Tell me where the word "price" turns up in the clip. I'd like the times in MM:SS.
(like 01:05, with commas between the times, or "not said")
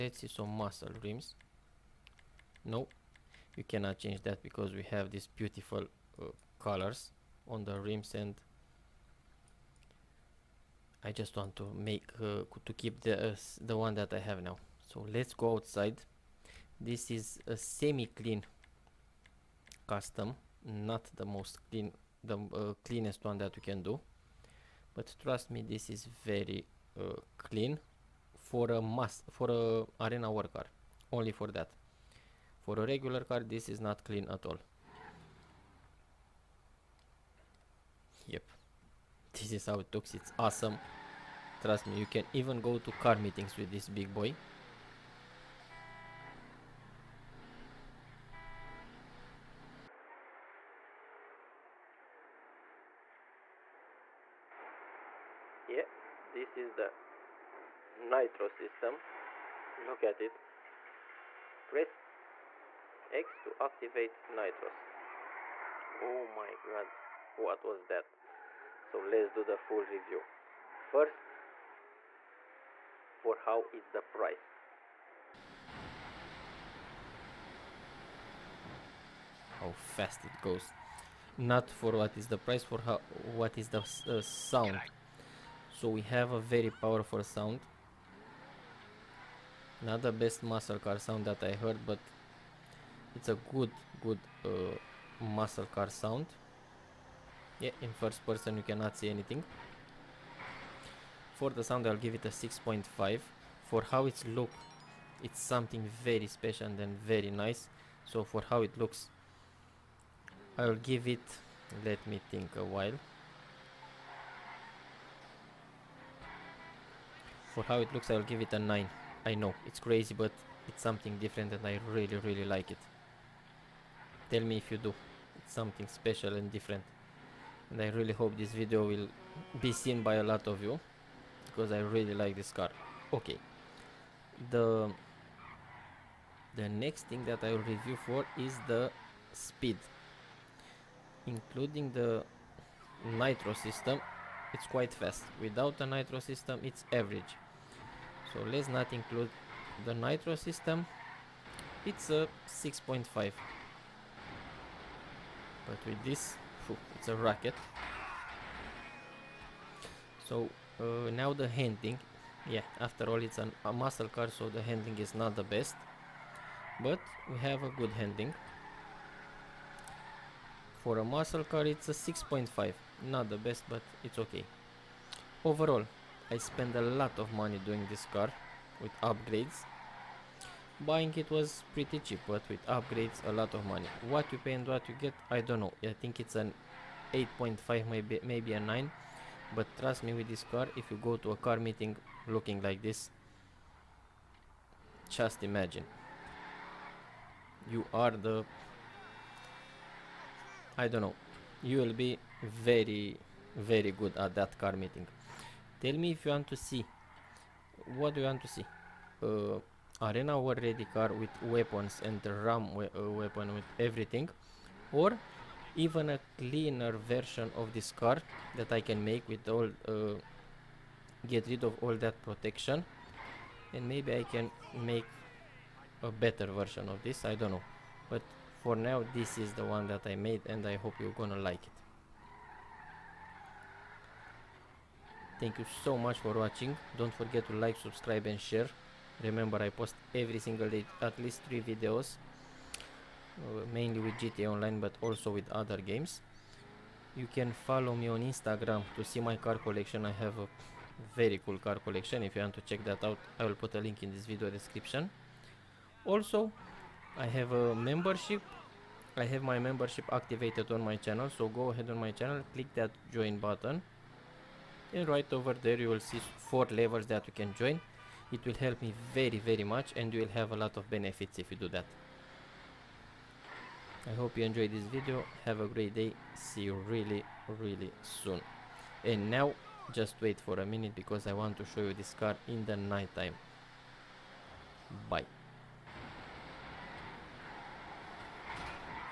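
01:14, 01:22.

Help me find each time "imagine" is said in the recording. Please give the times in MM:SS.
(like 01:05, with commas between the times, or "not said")
03:15.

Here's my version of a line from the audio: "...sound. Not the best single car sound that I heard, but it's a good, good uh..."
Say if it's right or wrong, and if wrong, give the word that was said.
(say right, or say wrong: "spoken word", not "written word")
wrong: "muscle", not "single".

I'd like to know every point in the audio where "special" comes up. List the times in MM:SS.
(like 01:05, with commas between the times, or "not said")
01:46, 02:05.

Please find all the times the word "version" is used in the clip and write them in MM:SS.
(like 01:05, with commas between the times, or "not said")
03:37, 03:46.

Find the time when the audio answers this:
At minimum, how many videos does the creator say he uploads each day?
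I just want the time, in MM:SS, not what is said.
04:01.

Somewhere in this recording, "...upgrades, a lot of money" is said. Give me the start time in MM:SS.
03:02.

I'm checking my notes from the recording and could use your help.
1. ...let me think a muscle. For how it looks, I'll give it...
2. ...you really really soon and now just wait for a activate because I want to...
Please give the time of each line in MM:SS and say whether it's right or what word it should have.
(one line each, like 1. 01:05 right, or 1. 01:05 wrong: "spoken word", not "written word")
1. 01:51 wrong: "while", not "muscle"
2. 04:36 wrong: "minute", not "activate".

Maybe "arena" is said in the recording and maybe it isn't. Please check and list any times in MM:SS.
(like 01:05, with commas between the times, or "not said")
00:30, 03:30.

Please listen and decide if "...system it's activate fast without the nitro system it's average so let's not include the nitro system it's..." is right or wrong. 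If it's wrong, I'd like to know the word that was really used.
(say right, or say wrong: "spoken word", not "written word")
wrong: "quite", not "activate".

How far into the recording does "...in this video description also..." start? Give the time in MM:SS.
04:14.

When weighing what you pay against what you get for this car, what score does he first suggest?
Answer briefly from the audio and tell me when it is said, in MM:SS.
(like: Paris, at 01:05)
8.5, at 03:07.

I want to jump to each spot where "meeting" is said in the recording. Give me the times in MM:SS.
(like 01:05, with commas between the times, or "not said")
00:43, 03:11, 03:24.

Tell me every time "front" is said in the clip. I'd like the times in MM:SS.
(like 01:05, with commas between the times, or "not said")
not said.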